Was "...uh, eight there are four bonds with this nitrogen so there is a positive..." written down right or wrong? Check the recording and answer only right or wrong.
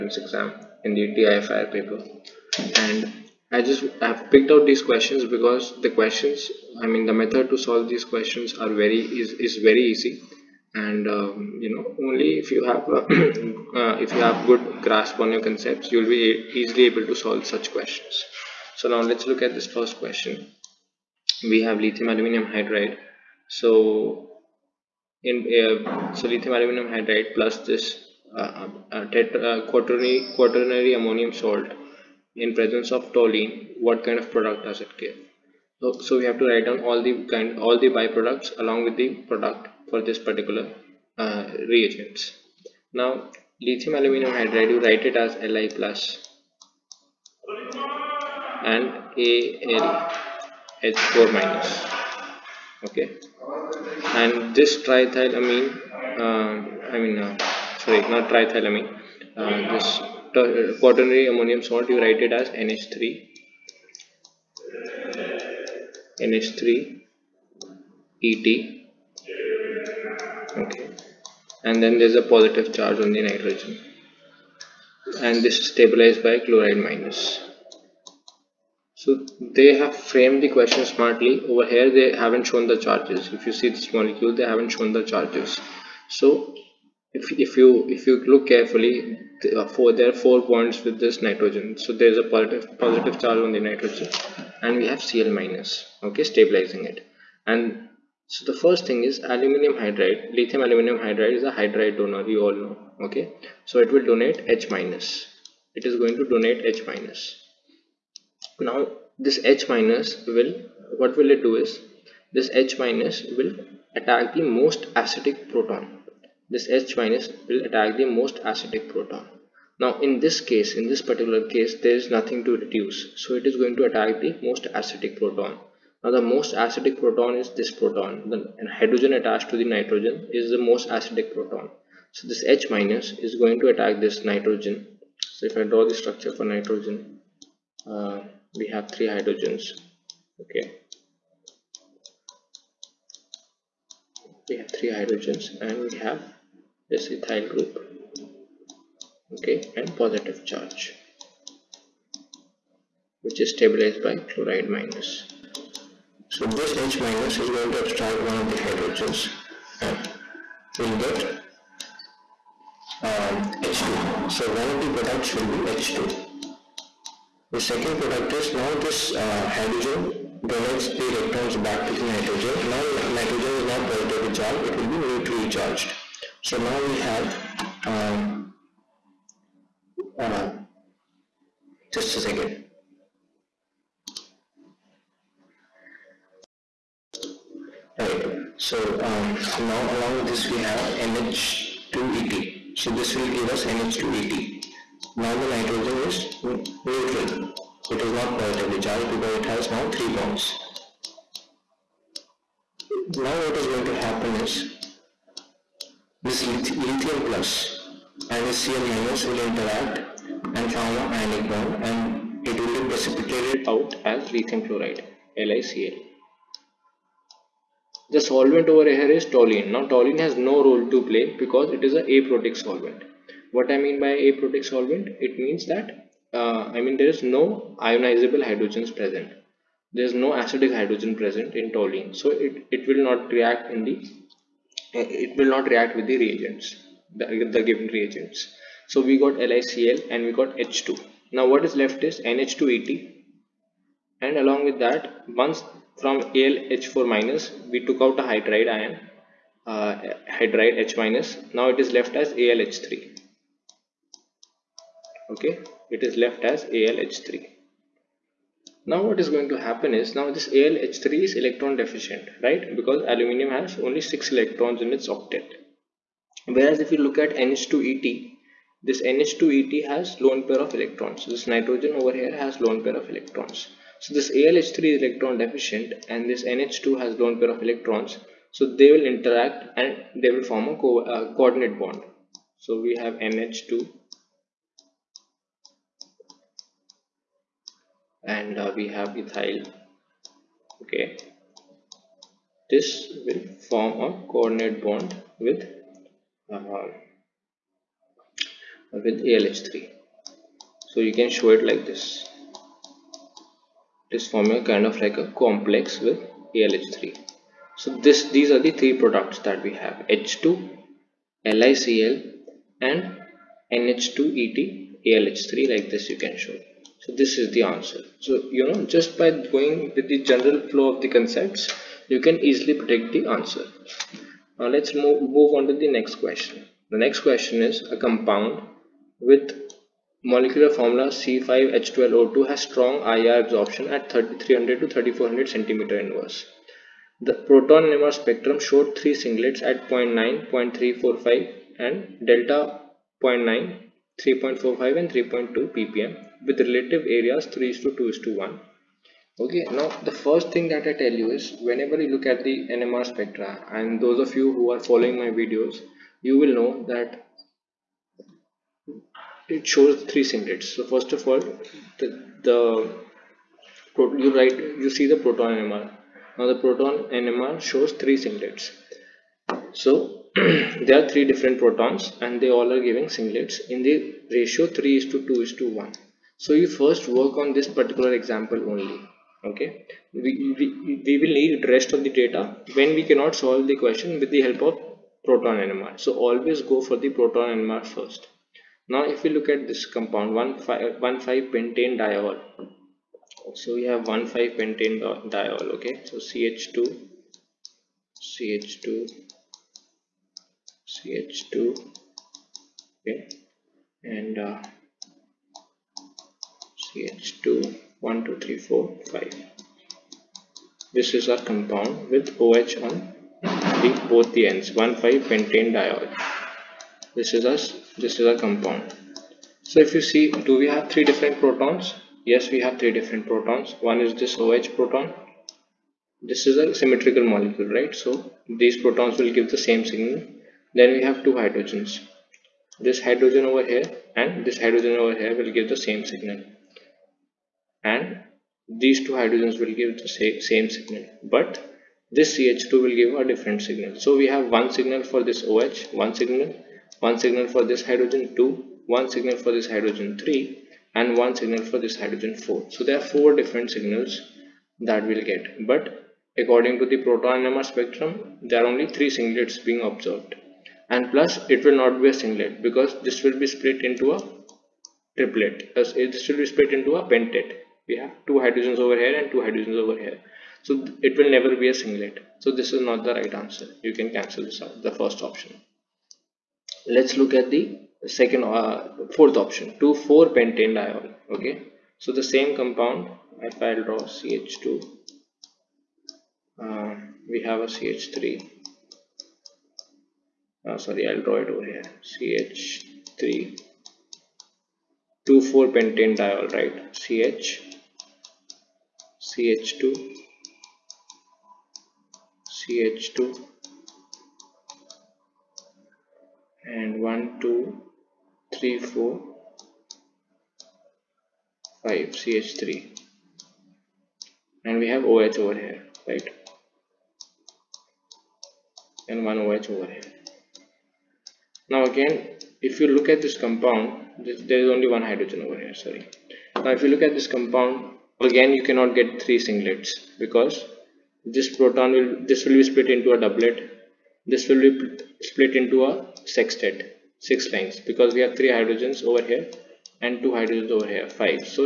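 wrong.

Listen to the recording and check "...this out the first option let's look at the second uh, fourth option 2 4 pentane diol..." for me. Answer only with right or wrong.
right.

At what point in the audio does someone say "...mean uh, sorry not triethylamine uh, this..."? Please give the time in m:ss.
0:56.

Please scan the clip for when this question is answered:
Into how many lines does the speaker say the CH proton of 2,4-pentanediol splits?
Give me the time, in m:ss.
8:57.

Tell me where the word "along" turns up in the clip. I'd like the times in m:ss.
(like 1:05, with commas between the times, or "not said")
0:38, 3:09, 4:04.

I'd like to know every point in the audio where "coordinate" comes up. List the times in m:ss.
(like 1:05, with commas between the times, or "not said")
4:41, 4:54.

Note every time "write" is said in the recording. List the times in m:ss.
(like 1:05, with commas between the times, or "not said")
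0:36, 0:44, 1:02, 6:04.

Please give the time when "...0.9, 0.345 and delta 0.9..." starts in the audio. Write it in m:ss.
5:39.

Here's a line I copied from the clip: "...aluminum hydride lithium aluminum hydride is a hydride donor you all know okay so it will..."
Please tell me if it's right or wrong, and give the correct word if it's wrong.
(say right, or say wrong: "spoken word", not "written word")
right.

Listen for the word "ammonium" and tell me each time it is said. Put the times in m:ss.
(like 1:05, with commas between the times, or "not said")
0:30, 1:01.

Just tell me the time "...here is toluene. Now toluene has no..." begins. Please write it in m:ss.
3:38.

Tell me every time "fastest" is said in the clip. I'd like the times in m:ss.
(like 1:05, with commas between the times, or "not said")
not said.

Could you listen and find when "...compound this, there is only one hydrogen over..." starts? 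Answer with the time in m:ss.
8:43.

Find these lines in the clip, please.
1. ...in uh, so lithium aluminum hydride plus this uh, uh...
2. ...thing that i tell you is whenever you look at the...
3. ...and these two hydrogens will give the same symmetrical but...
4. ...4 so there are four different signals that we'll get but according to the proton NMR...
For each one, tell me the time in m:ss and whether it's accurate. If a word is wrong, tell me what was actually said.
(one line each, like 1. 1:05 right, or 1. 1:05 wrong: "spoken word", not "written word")
1. 0:25 right
2. 5:50 right
3. 7:17 wrong: "signal", not "symmetrical"
4. 7:32 right.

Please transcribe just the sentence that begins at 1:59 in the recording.
Now in this case, in this particular case, there is nothing to reduce.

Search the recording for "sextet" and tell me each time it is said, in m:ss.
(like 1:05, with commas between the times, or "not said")
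8:56.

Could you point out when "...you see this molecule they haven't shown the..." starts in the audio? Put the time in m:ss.
1:23.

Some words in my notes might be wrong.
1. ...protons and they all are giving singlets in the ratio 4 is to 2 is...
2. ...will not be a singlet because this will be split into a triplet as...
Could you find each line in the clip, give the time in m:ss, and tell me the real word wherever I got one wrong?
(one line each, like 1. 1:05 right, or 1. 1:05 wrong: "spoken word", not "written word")
1. 6:11 wrong: "3", not "4"
2. 7:41 right.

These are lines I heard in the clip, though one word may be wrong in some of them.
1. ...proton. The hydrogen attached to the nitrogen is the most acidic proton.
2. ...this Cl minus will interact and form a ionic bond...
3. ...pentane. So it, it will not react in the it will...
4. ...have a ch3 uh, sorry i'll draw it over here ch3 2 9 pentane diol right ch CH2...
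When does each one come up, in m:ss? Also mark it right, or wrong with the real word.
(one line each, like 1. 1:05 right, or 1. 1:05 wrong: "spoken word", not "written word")
1. 2:07 right
2. 3:28 right
3. 3:51 wrong: "toluene", not "pentane"
4. 8:07 wrong: "4", not "9".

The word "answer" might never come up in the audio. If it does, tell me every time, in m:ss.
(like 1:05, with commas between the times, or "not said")
5:17, 5:23, 7:53.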